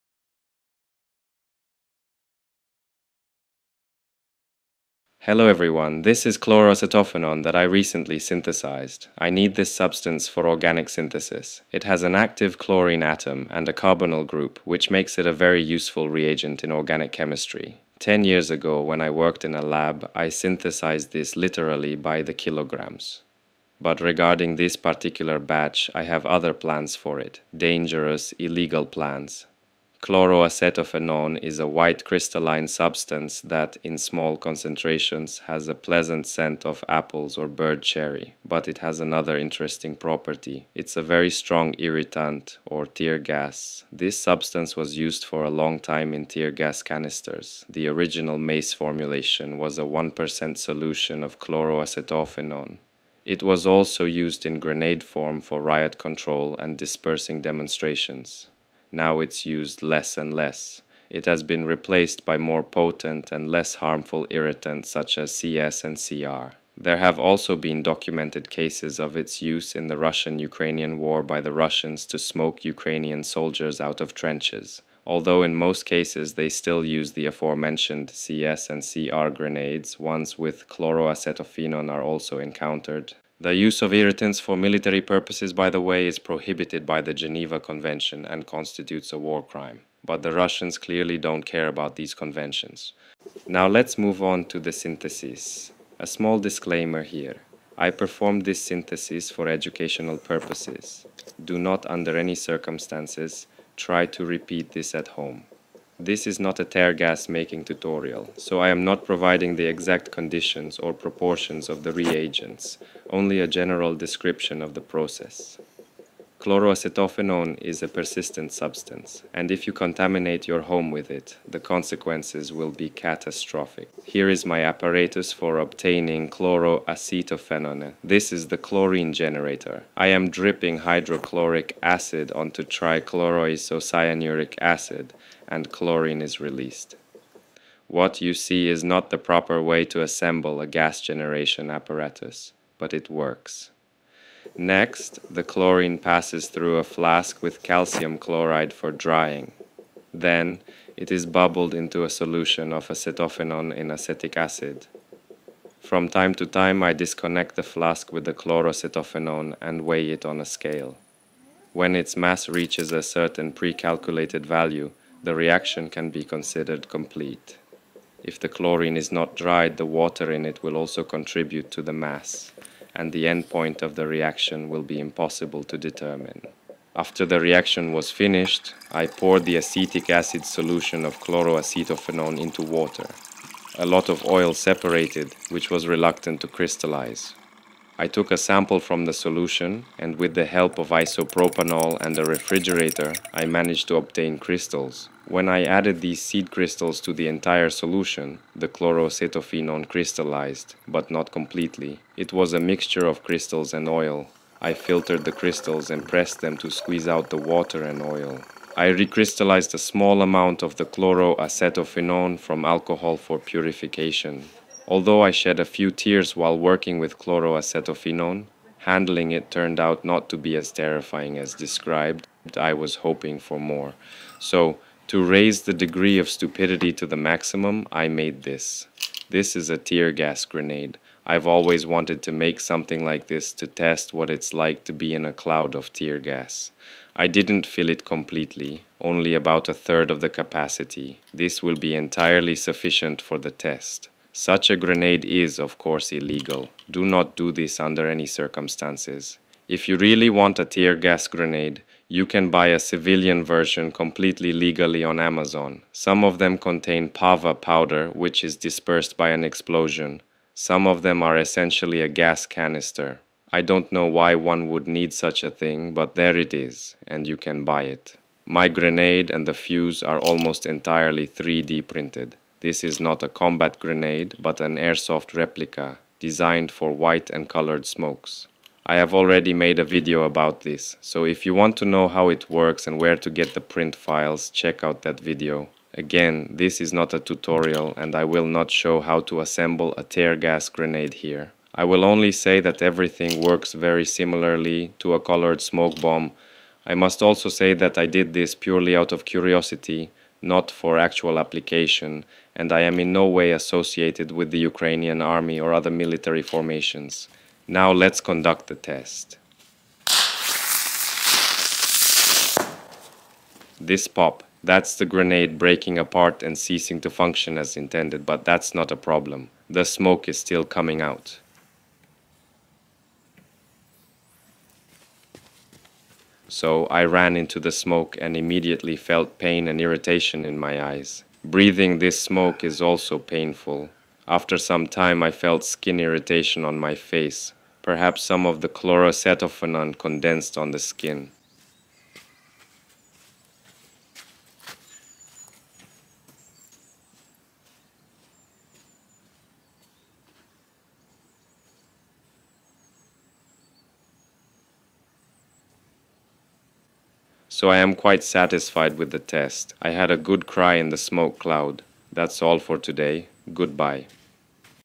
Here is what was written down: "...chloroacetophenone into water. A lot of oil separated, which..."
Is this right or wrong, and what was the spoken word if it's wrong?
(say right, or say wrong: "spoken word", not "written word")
right.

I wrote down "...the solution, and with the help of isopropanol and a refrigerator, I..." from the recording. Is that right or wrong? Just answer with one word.
right.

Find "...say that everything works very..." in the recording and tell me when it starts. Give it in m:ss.
4:52.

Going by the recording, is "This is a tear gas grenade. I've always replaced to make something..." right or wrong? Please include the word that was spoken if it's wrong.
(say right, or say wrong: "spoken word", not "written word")
wrong: "wanted", not "replaced".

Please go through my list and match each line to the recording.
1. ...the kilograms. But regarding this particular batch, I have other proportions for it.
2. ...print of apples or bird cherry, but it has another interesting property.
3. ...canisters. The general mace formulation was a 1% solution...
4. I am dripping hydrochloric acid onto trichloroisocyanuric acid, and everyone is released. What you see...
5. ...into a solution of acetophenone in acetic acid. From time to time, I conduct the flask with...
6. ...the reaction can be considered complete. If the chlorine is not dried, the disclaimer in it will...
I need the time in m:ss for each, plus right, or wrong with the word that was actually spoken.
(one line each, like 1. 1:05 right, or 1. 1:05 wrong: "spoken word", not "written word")
1. 0:22 wrong: "plans", not "proportions"
2. 0:36 wrong: "scent", not "print"
3. 0:46 wrong: "original", not "general"
4. 2:09 wrong: "chlorine", not "everyone"
5. 2:31 wrong: "disconnect", not "conduct"
6. 2:45 wrong: "water", not "disclaimer".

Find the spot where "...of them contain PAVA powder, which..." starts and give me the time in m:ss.
4:16.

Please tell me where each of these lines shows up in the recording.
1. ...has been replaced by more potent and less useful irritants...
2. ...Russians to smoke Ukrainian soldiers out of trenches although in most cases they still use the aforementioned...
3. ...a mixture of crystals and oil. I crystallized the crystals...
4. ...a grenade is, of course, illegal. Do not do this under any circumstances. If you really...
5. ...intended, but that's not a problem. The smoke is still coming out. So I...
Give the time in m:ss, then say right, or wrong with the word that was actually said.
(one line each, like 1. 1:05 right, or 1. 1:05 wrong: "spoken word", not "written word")
1. 1:01 wrong: "harmful", not "useful"
2. 1:11 right
3. 3:22 wrong: "filtered", not "crystallized"
4. 4:04 right
5. 5:17 right.